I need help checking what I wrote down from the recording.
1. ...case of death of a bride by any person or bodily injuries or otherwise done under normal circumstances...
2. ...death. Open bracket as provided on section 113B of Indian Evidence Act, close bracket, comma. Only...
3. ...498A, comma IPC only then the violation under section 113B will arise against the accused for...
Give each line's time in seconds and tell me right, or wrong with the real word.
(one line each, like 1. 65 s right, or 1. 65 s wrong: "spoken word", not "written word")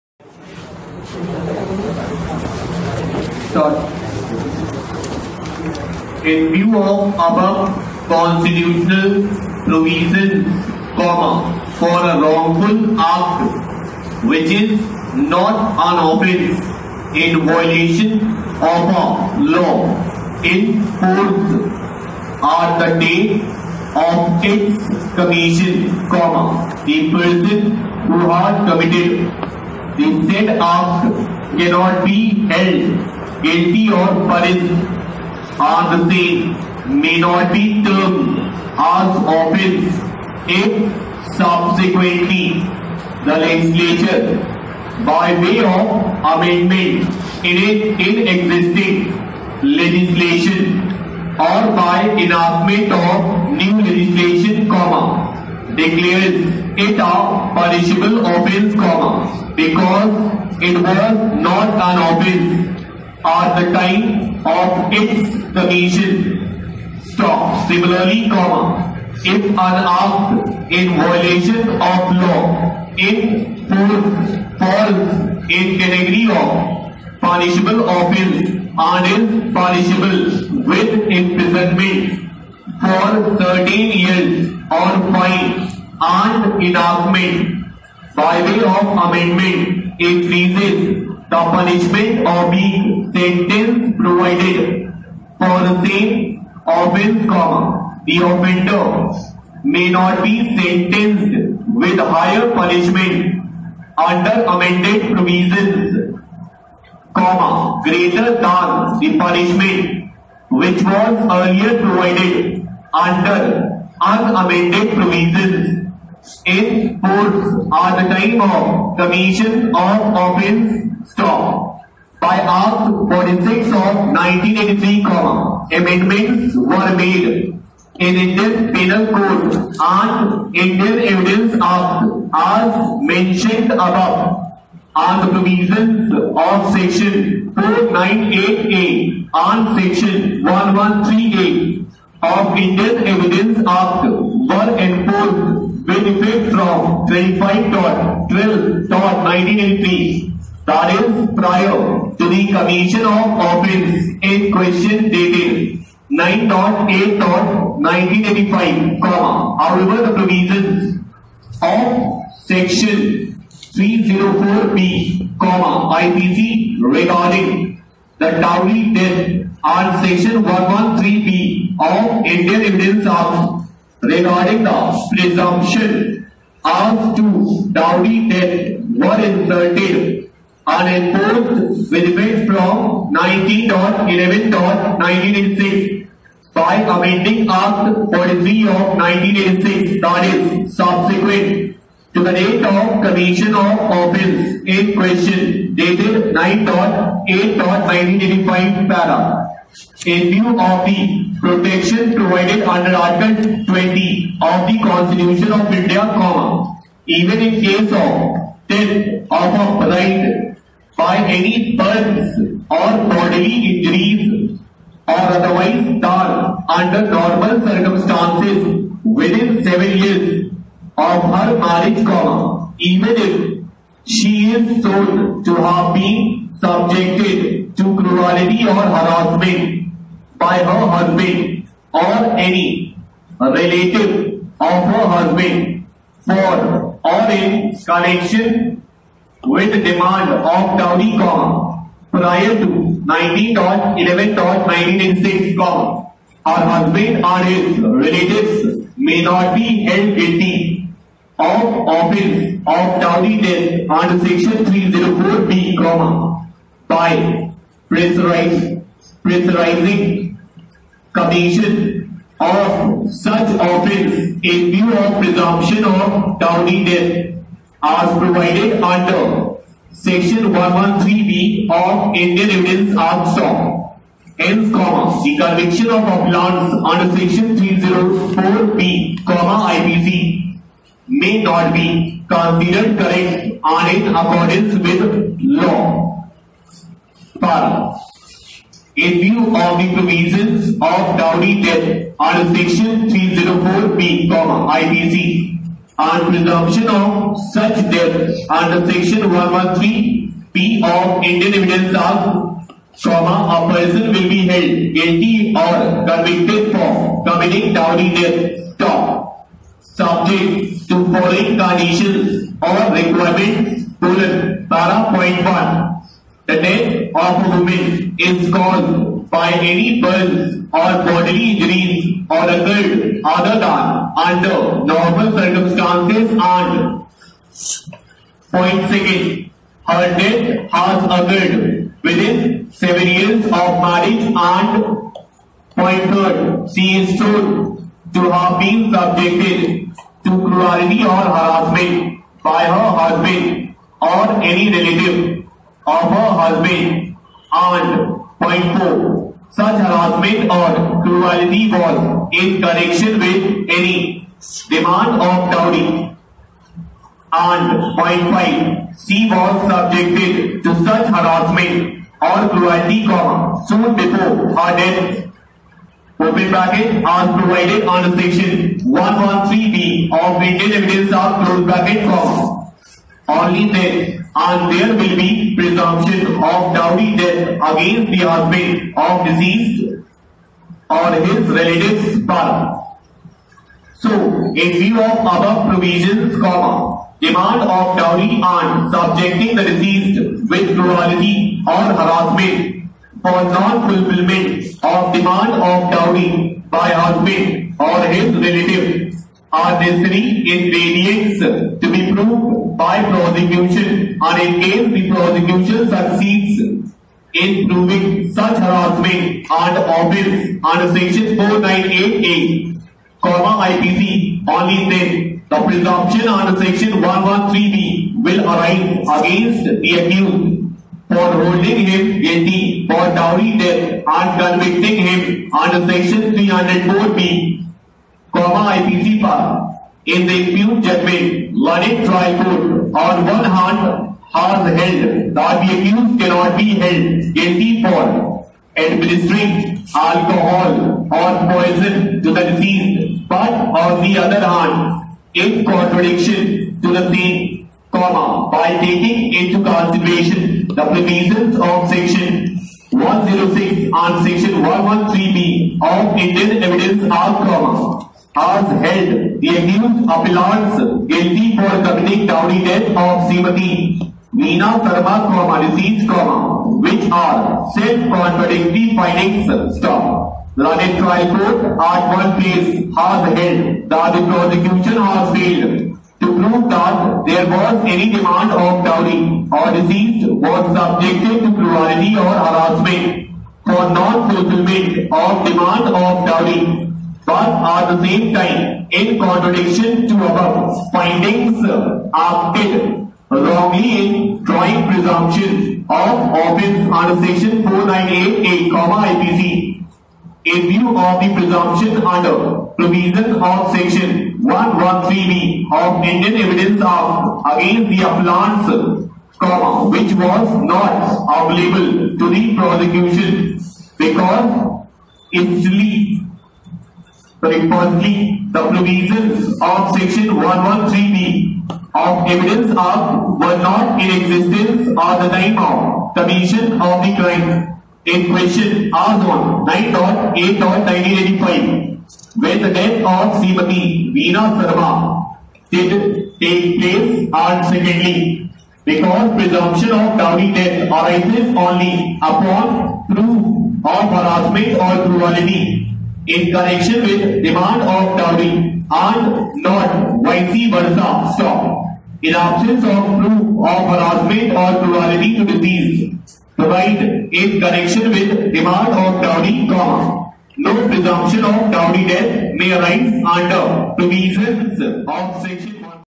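1. 207 s right
2. 364 s right
3. 411 s wrong: "presumption", not "violation".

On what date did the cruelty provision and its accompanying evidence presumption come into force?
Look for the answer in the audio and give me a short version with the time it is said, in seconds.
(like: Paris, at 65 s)
25.12.1983, at 147 s.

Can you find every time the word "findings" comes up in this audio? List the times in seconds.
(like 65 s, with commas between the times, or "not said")
468 s, 490 s.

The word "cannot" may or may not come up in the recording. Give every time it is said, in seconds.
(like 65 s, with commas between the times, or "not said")
31 s, 436 s.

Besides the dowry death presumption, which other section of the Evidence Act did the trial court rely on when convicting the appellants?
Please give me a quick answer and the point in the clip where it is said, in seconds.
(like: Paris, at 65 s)
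Section 106, at 451 s.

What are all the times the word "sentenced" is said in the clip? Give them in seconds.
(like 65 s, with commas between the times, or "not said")
93 s, 100 s.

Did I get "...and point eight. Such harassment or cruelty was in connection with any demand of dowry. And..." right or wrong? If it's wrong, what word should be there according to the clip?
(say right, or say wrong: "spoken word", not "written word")
wrong: "four", not "eight".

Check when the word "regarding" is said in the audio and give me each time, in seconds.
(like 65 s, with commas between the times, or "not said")
166 s, 174 s.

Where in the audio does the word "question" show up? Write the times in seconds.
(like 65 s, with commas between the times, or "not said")
154 s, 194 s, 528 s.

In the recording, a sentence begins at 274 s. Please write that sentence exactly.
Hence, comma, the conviction of offense under Section 304B, comma, IPC may not be considered correct and in accordance with law.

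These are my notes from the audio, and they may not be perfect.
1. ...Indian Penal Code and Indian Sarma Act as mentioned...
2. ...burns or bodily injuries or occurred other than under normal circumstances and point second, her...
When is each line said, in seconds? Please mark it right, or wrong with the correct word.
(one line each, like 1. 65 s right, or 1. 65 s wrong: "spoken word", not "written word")
1. 128 s wrong: "Evidence", not "Sarma"
2. 320 s right.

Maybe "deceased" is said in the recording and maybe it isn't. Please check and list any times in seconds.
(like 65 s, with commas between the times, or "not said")
379 s, 389 s, 442 s, 465 s, 479 s.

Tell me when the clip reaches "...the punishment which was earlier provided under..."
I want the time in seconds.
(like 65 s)
108 s.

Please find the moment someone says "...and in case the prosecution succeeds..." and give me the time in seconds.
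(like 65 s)
404 s.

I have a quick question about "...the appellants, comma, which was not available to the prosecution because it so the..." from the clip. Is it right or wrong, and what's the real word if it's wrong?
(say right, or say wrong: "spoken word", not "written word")
right.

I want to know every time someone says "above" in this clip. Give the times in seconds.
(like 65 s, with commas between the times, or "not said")
7 s, 133 s, 385 s.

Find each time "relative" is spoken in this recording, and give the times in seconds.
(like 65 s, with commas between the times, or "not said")
233 s, 247 s, 344 s, 381 s, 398 s.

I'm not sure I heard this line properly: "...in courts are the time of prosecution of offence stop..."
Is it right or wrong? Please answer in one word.
wrong.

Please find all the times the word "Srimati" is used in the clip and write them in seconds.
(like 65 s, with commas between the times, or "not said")
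463 s, 533 s.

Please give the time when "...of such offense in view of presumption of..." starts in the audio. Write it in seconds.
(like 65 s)
262 s.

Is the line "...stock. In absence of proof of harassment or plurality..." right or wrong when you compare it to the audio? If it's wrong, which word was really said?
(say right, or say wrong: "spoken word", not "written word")
right.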